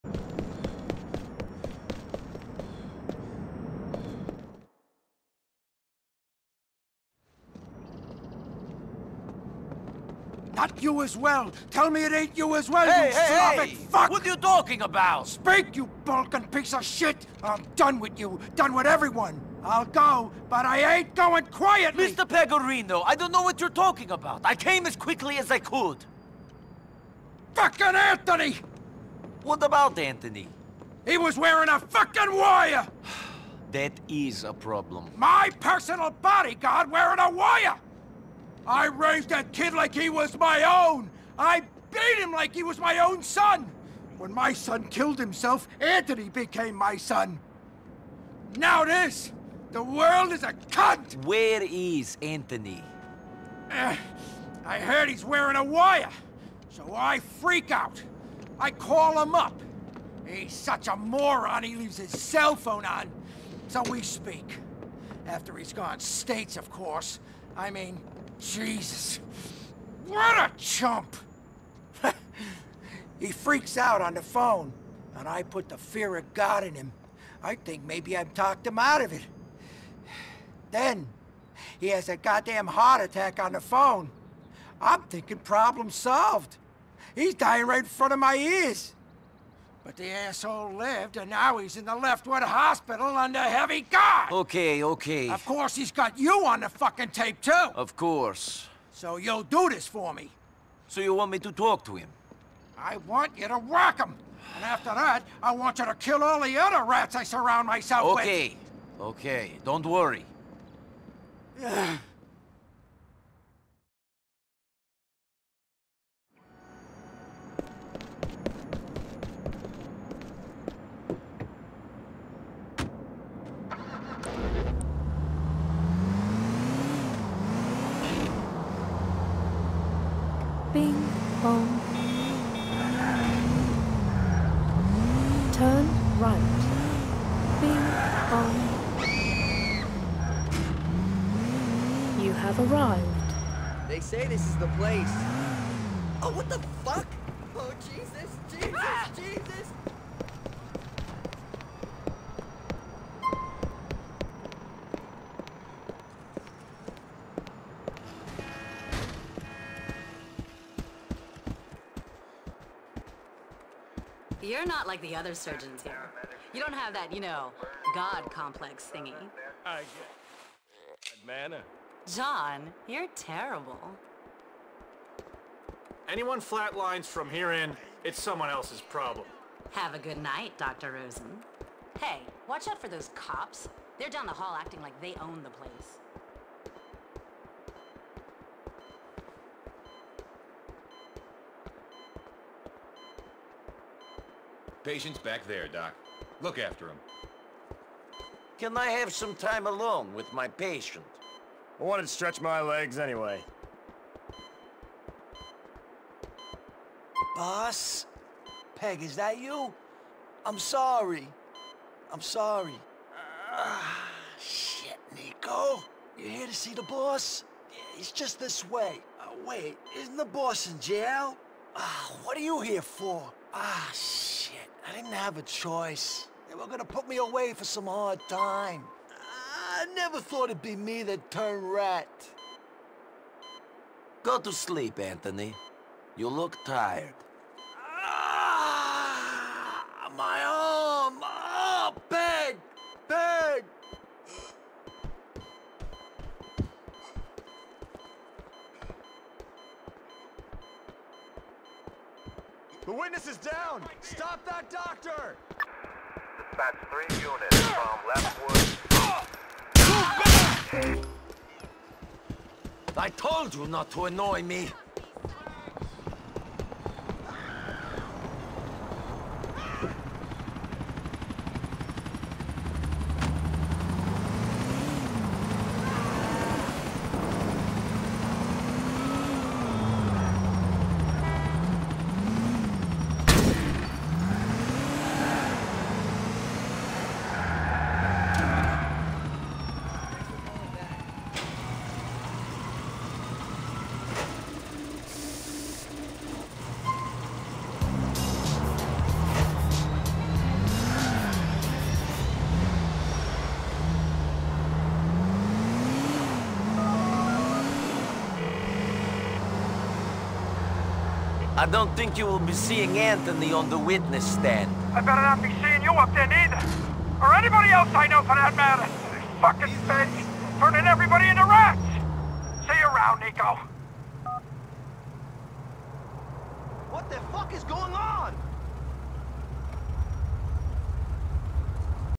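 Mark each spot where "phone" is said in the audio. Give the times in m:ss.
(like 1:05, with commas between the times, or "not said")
1:02, 1:14, 1:23.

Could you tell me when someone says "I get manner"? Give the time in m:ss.
2:49.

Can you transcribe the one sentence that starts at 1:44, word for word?
And after that, I want you to kill all the other rats I surround myself okay.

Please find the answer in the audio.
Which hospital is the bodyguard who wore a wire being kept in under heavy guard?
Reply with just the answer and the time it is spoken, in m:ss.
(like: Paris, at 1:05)
Leftwood Hospital, at 1:31.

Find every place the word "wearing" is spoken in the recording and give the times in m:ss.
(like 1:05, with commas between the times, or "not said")
0:31, 0:36, 0:55.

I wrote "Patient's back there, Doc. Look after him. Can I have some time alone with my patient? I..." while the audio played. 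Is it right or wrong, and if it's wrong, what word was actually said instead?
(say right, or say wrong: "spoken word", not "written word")
right.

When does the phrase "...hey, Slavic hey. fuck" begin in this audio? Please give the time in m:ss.
0:13.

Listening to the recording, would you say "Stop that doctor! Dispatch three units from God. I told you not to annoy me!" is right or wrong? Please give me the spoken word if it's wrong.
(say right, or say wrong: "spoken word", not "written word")
wrong: "Leftwood", not "God".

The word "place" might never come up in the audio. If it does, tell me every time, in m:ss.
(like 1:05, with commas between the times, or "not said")
2:24, 3:05.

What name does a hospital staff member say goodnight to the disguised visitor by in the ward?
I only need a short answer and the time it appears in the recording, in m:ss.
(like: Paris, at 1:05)
Dr. Rosen, at 3:00.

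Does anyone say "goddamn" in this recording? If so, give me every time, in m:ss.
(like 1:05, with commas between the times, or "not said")
1:22.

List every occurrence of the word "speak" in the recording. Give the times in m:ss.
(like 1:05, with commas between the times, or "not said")
0:15, 1:04.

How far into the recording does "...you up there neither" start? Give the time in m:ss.
5:15.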